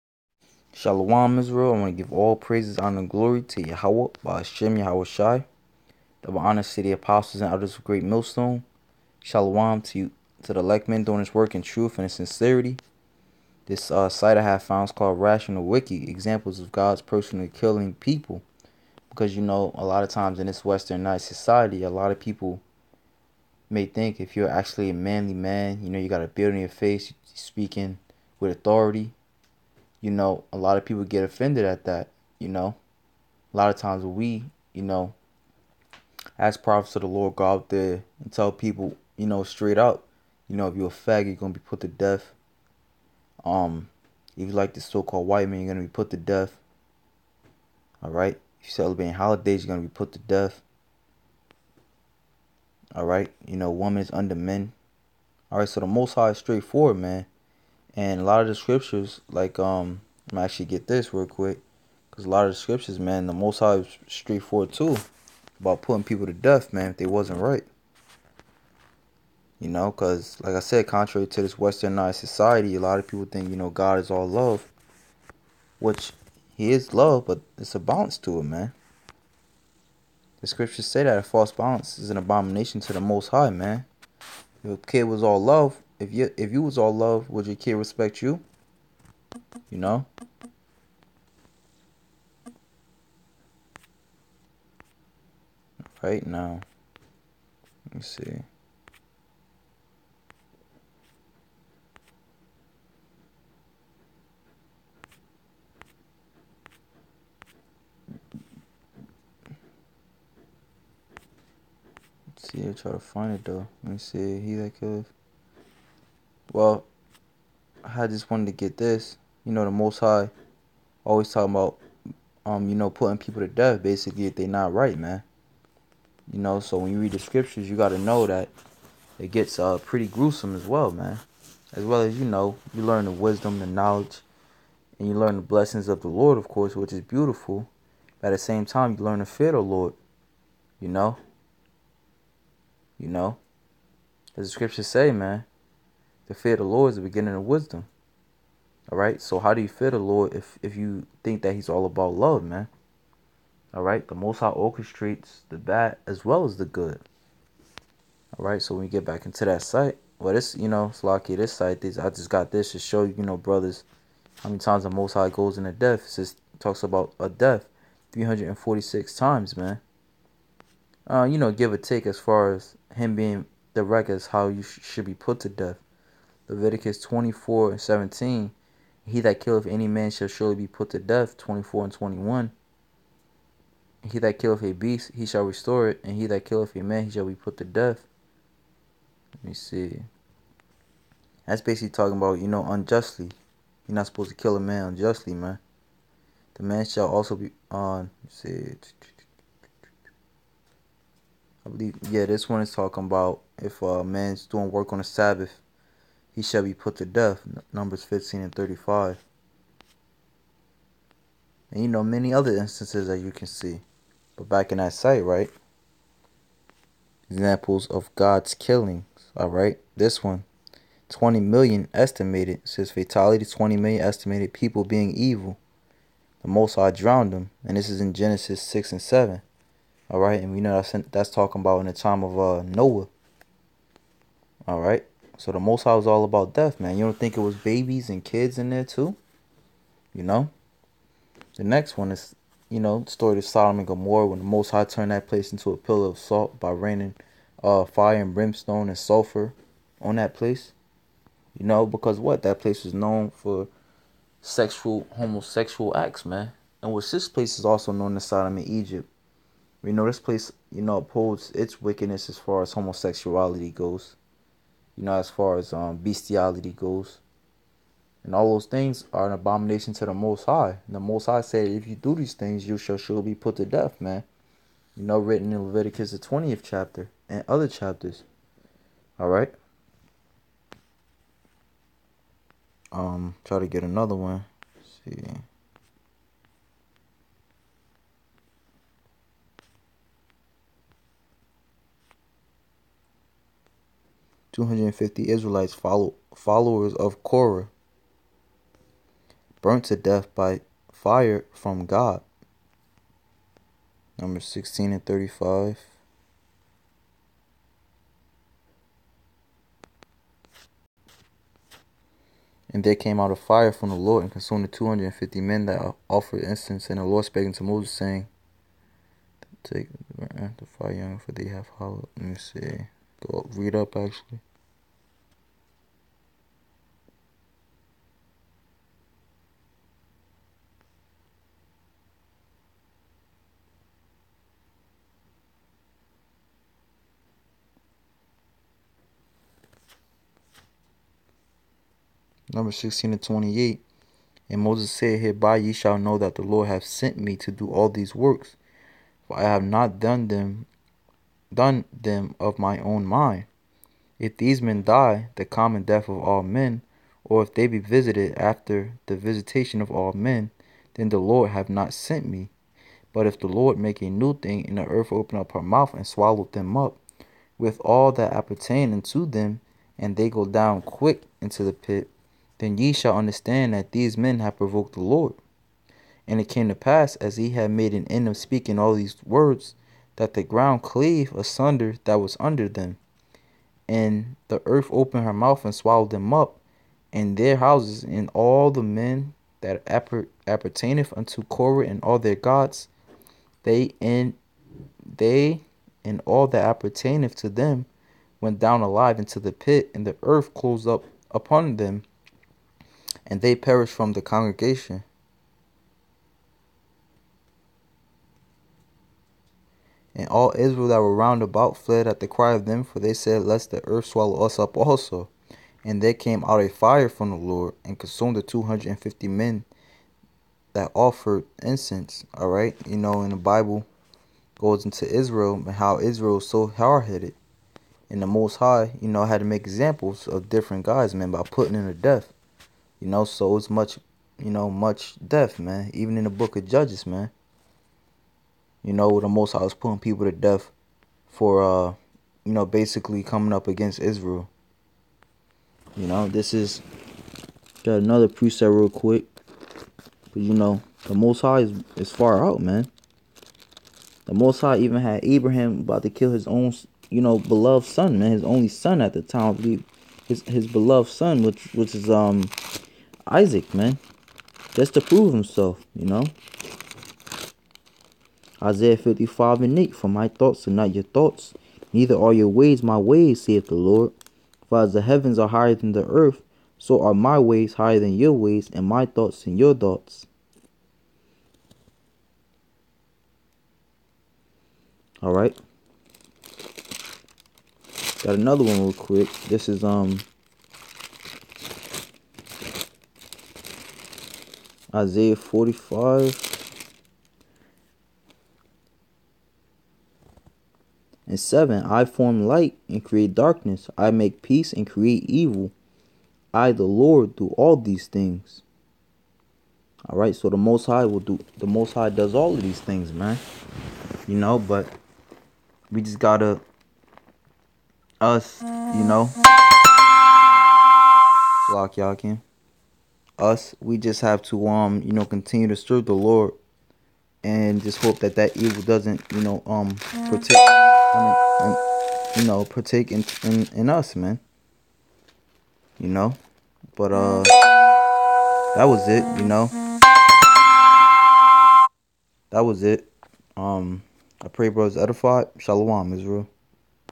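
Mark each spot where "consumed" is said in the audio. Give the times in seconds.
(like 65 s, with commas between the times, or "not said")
314 s, 417 s.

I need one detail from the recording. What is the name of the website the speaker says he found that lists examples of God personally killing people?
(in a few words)
Rational Wiki.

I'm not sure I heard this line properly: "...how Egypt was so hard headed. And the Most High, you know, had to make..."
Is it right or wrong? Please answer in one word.
wrong.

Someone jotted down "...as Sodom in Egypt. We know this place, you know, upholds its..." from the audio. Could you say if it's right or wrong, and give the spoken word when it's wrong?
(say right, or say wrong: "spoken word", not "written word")
right.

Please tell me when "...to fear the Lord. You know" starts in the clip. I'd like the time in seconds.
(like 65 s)
139 s.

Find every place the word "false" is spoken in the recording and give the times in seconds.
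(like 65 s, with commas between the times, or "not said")
81 s.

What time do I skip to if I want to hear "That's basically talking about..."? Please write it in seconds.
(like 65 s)
191 s.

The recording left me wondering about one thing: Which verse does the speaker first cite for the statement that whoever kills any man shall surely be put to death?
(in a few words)
Leviticus 24:17.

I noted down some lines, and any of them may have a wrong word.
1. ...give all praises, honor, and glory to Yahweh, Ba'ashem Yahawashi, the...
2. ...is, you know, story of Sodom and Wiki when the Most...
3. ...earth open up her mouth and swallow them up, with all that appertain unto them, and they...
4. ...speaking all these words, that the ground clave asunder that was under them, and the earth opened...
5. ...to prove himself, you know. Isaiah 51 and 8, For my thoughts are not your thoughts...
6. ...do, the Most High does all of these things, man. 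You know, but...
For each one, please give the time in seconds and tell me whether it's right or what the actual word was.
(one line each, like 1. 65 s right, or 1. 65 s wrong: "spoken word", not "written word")
1. 2 s right
2. 242 s wrong: "Gomorrah", not "Wiki"
3. 364 s right
4. 378 s right
5. 464 s wrong: "55", not "51"
6. 511 s right.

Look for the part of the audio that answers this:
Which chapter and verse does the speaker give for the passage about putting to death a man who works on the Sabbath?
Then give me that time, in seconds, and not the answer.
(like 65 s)
207 s.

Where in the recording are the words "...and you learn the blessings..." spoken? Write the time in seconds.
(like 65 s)
134 s.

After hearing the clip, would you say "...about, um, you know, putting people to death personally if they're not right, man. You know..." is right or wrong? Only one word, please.
wrong.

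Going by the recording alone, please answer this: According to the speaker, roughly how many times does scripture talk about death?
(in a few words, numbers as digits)
346.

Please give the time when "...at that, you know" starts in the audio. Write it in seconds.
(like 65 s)
31 s.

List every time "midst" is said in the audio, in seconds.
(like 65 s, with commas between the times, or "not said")
not said.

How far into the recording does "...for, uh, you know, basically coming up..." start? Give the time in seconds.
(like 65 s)
441 s.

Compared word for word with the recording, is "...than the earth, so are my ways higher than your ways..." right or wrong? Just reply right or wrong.
right.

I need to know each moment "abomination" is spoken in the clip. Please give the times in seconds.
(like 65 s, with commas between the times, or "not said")
82 s, 269 s.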